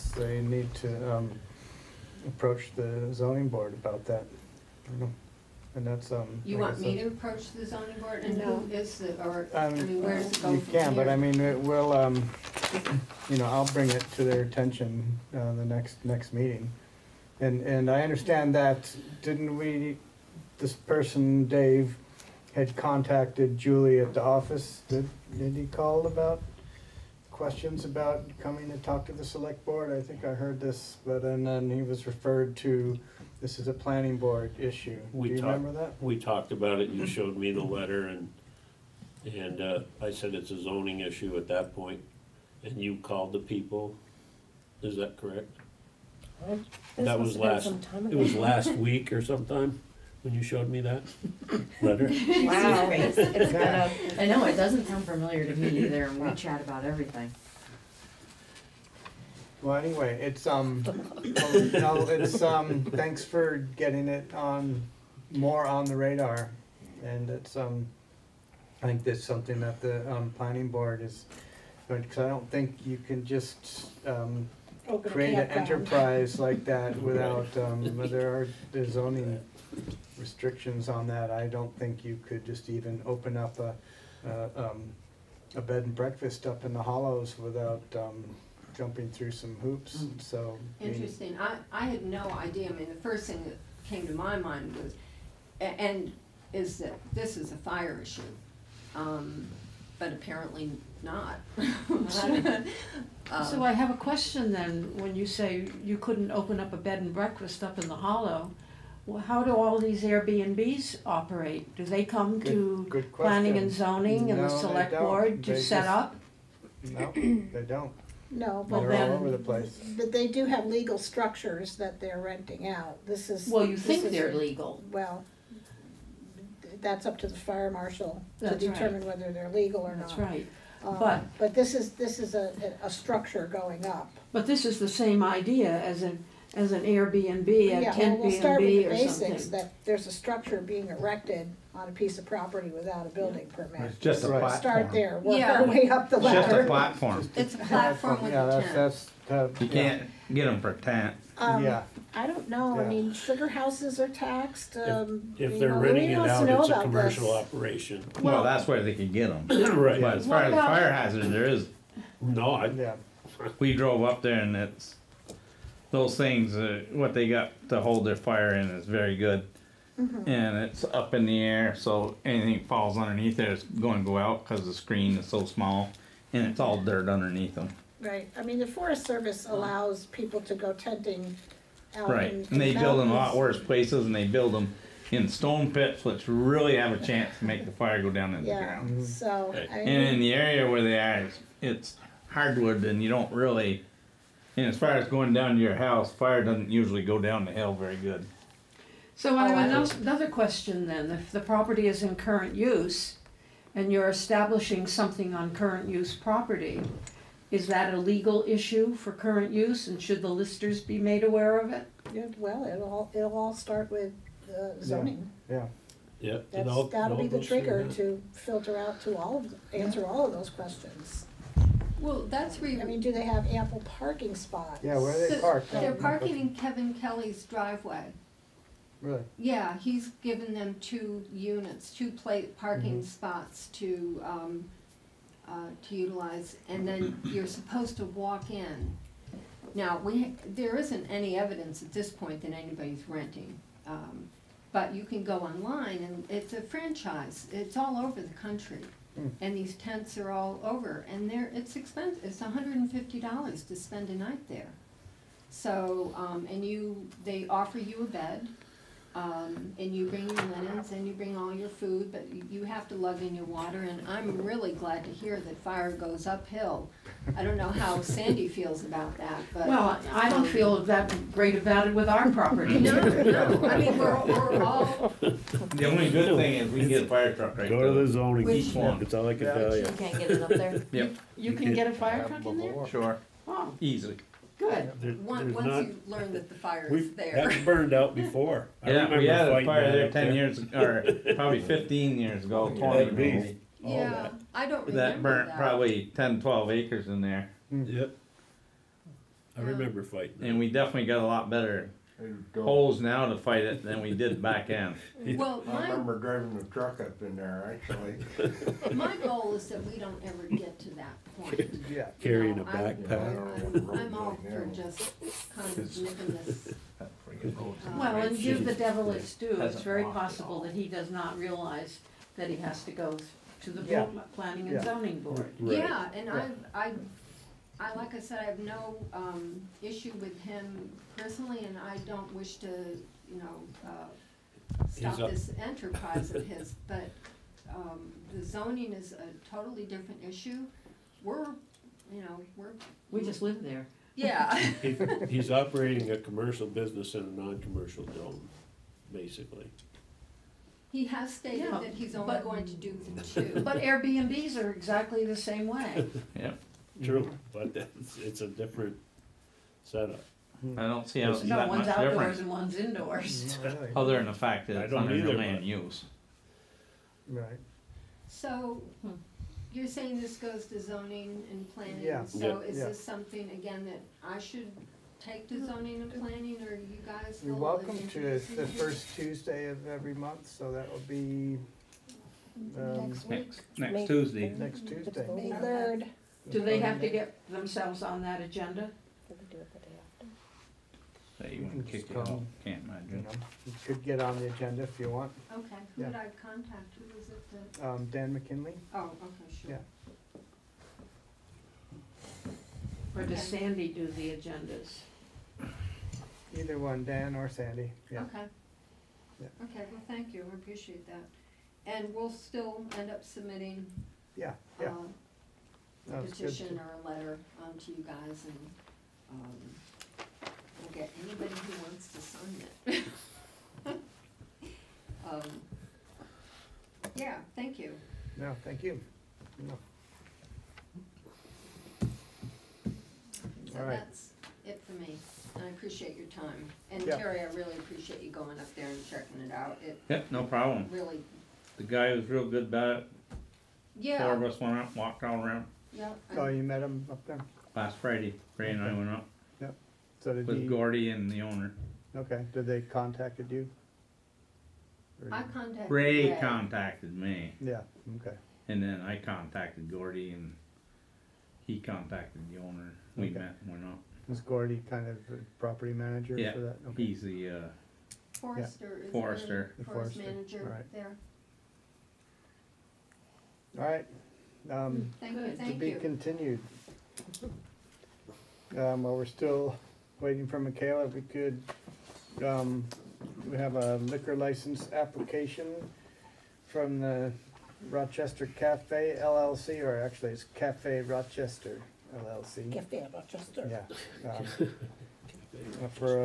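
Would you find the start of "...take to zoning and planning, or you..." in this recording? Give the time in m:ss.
6:15.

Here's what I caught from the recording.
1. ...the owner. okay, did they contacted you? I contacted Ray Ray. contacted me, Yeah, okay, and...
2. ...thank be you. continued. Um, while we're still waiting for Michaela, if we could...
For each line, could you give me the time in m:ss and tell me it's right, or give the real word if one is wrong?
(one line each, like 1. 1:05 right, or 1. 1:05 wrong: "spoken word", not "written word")
1. 7:31 right
2. 7:55 right.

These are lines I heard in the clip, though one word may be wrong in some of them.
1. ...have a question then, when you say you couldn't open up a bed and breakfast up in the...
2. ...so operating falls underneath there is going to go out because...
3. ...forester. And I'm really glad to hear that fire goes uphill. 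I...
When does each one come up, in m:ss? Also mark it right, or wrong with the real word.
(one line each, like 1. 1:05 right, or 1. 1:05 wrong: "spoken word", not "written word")
1. 1:43 right
2. 2:51 wrong: "anything", not "operating"
3. 4:23 wrong: "water", not "forester".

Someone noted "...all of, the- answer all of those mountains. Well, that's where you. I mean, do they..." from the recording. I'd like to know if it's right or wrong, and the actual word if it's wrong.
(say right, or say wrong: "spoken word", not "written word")
wrong: "questions", not "mountains".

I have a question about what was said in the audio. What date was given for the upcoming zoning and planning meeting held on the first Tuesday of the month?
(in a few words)
May 3.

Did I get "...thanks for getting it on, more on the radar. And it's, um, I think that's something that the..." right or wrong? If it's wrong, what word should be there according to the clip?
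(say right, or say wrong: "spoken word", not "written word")
right.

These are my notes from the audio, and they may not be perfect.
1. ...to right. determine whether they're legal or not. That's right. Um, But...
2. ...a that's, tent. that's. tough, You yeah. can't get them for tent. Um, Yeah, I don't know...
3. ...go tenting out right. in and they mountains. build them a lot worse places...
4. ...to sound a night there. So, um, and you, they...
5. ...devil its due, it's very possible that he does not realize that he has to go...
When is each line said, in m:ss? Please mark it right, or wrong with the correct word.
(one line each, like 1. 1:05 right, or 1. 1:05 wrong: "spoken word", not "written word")
1. 2:08 right
2. 2:28 right
3. 3:00 right
4. 4:13 wrong: "spend", not "sound"
5. 5:18 right.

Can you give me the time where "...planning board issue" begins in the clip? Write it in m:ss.
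0:33.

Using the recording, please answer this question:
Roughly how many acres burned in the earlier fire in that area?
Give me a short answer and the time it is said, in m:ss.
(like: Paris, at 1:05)
10 to 12 acres, at 4:56.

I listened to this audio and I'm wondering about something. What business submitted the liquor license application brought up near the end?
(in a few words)
Cafe Rochester LLC.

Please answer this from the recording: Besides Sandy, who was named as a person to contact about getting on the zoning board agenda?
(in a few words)
Dan McKinley.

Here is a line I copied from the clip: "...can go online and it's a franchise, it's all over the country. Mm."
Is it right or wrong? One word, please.
right.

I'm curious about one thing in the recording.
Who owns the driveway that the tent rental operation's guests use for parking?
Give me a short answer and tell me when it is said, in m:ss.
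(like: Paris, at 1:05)
Kevin Kelly, at 3:46.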